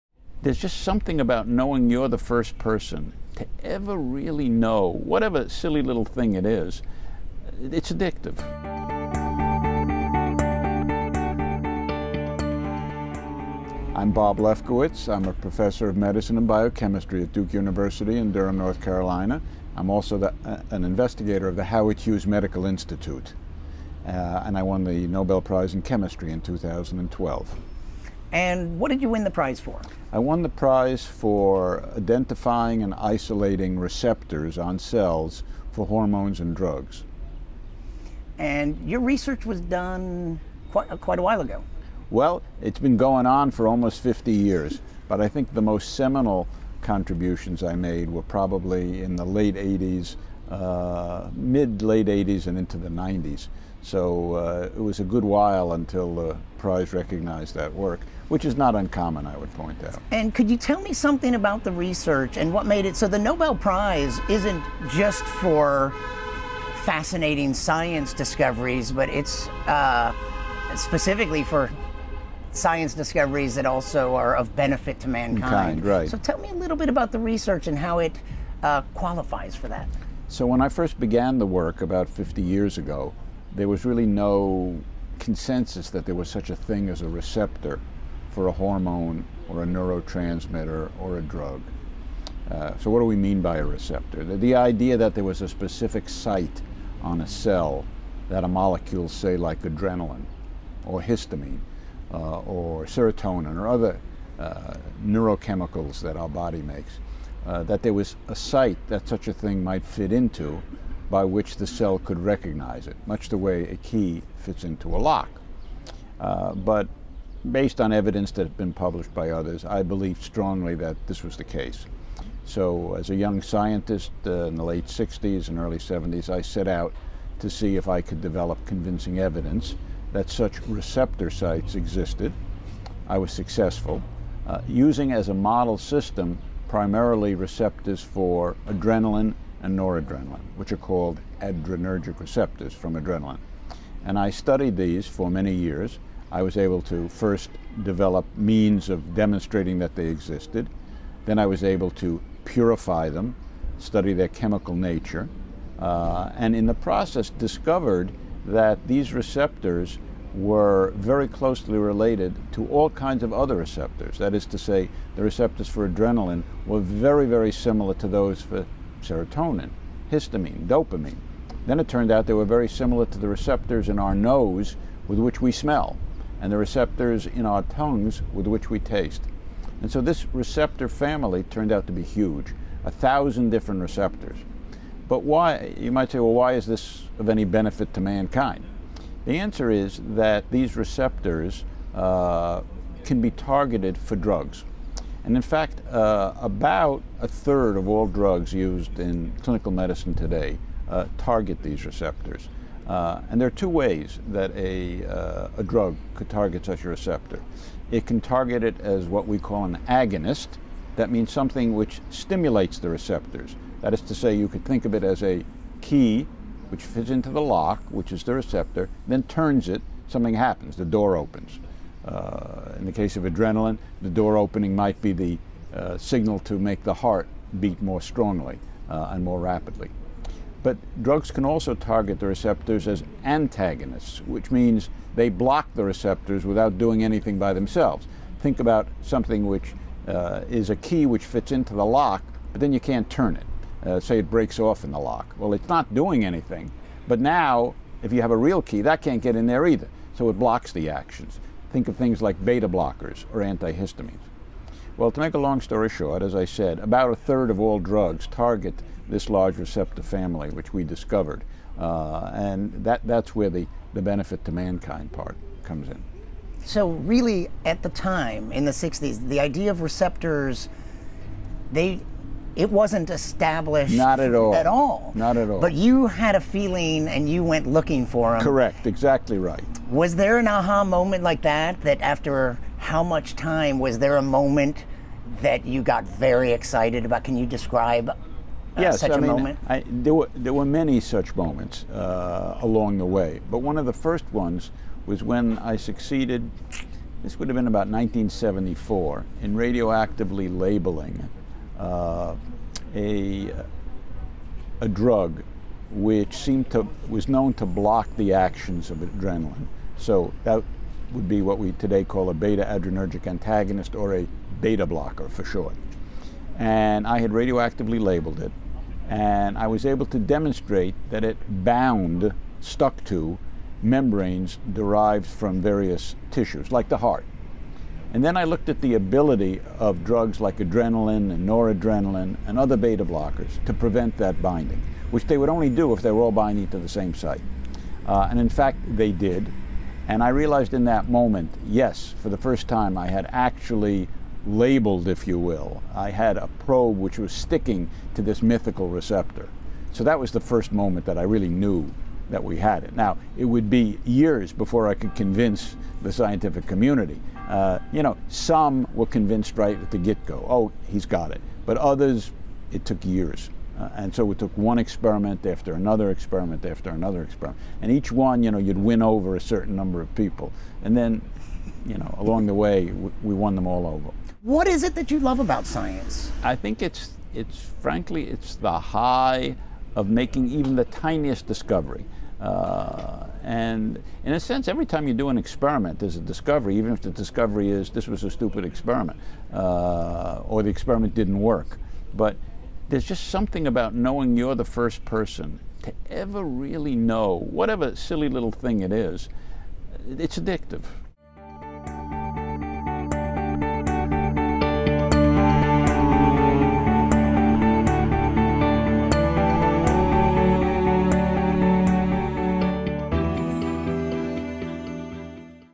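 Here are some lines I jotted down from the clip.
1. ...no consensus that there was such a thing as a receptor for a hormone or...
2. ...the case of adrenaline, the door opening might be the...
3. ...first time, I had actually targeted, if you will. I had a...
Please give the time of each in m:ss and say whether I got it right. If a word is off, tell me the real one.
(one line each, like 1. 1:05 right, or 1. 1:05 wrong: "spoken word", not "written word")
1. 1:24 right
2. 3:42 right
3. 5:42 wrong: "labeled", not "targeted".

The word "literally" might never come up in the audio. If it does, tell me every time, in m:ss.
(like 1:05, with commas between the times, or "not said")
not said.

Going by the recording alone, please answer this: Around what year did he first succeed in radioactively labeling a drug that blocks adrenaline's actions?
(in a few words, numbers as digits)
1974.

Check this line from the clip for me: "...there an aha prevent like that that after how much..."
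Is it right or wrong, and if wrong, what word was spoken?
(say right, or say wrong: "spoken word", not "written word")
wrong: "moment", not "prevent".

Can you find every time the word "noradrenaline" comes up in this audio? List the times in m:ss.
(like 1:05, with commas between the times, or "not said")
2:19, 5:31.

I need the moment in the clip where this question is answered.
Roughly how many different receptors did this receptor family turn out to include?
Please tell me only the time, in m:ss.
3:02.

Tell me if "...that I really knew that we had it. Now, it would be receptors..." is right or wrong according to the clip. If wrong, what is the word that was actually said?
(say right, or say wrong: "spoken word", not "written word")
wrong: "years", not "receptors".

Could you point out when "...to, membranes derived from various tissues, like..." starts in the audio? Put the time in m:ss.
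5:23.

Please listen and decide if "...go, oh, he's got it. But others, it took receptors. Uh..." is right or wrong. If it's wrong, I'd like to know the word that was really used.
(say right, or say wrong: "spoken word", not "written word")
wrong: "years", not "receptors".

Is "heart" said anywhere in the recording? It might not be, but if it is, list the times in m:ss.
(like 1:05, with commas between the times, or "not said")
3:46, 5:26.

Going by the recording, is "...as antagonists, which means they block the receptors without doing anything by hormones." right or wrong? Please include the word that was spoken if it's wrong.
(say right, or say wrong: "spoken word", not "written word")
wrong: "themselves", not "hormones".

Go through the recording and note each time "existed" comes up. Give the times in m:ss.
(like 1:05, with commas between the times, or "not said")
2:11, 2:30.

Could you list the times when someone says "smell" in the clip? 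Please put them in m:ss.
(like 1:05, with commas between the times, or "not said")
2:55.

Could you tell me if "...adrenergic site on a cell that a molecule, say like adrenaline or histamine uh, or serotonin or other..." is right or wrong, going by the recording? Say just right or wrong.
wrong.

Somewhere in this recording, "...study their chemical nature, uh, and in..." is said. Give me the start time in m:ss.
2:33.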